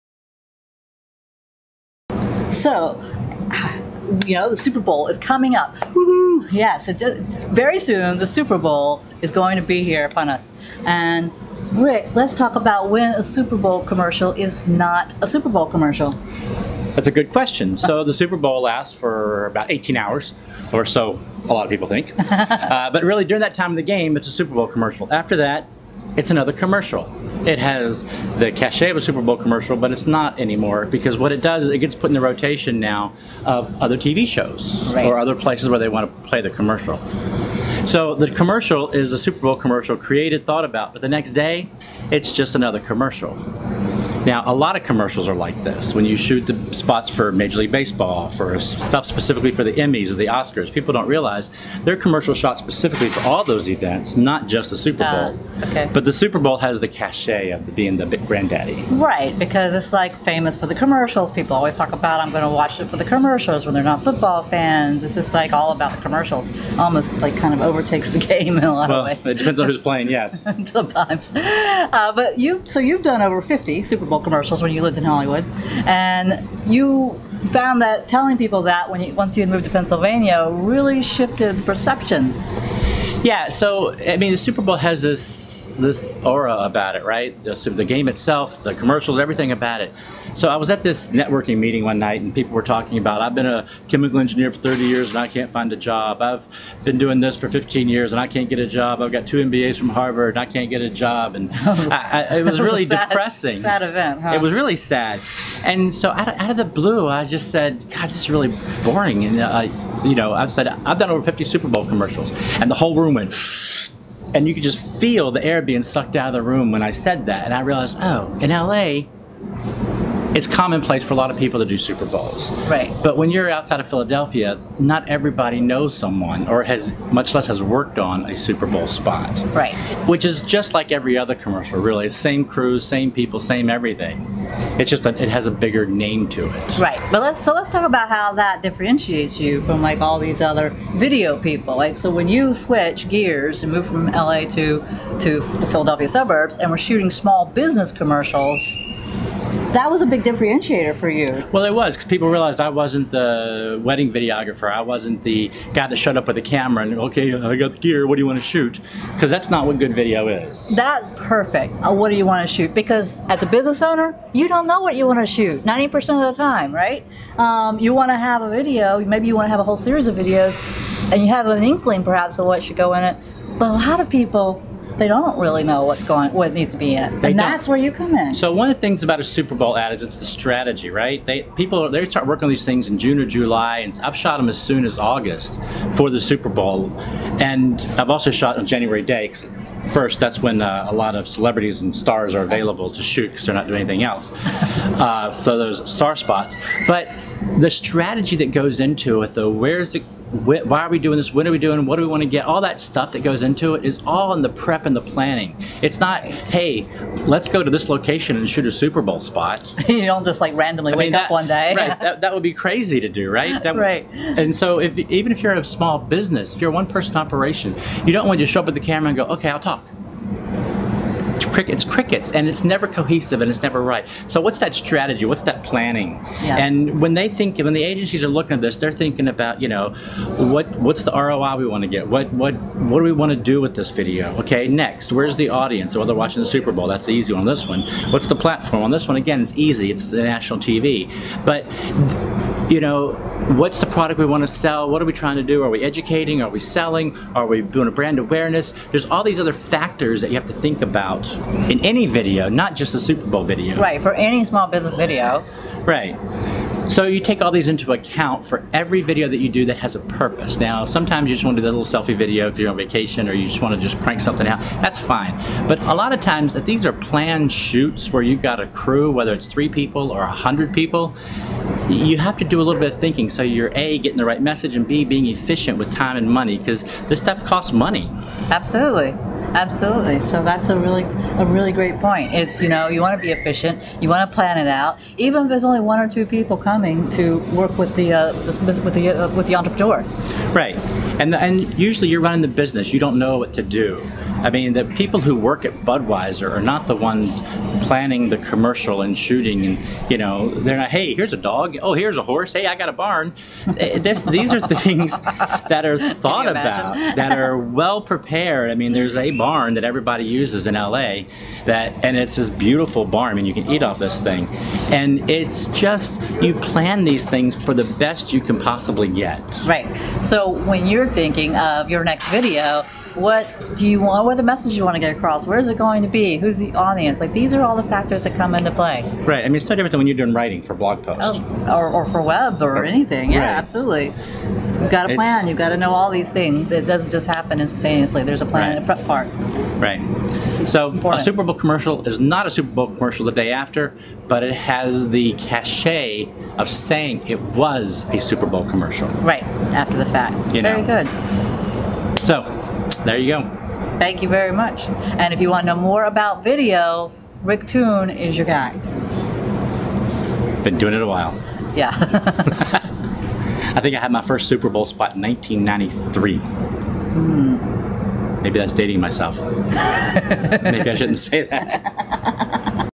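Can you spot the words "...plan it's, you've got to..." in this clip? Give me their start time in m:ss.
5:35.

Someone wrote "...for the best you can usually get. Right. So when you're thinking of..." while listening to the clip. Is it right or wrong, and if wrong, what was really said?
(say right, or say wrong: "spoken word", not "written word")
wrong: "possibly", not "usually".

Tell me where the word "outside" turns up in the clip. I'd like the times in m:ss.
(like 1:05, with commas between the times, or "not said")
2:03.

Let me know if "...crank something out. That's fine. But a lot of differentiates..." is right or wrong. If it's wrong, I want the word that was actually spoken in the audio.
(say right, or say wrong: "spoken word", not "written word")
wrong: "times", not "differentiates".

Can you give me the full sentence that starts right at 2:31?
Well, it was because people realized I wasn't the wedding videographer.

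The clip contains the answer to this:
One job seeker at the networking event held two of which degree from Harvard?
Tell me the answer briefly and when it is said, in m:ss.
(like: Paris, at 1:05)
MBAs, at 1:39.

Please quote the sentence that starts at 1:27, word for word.
The, the game itself, the commercials, everything about it.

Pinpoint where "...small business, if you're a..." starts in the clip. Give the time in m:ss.
3:35.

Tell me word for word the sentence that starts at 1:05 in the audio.
It's just like all about the commercials.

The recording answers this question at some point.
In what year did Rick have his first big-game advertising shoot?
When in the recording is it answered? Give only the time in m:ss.
6:05.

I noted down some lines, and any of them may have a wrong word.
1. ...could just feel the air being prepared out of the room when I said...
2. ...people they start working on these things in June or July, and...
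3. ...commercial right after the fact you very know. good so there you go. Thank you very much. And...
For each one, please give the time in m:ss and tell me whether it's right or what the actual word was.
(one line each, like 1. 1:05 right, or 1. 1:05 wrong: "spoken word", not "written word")
1. 1:54 wrong: "sucked", not "prepared"
2. 3:01 right
3. 5:48 right.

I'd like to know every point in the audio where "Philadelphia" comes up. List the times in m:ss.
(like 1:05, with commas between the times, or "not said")
2:03, 2:25.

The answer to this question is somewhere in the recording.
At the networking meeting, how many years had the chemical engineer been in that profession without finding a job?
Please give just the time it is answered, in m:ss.
1:34.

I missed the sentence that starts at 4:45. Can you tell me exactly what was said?
Even if there's only one or two people coming to work with the uh, with the uh, with the entrepreneur.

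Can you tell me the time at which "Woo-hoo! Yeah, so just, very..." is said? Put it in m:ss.
0:05.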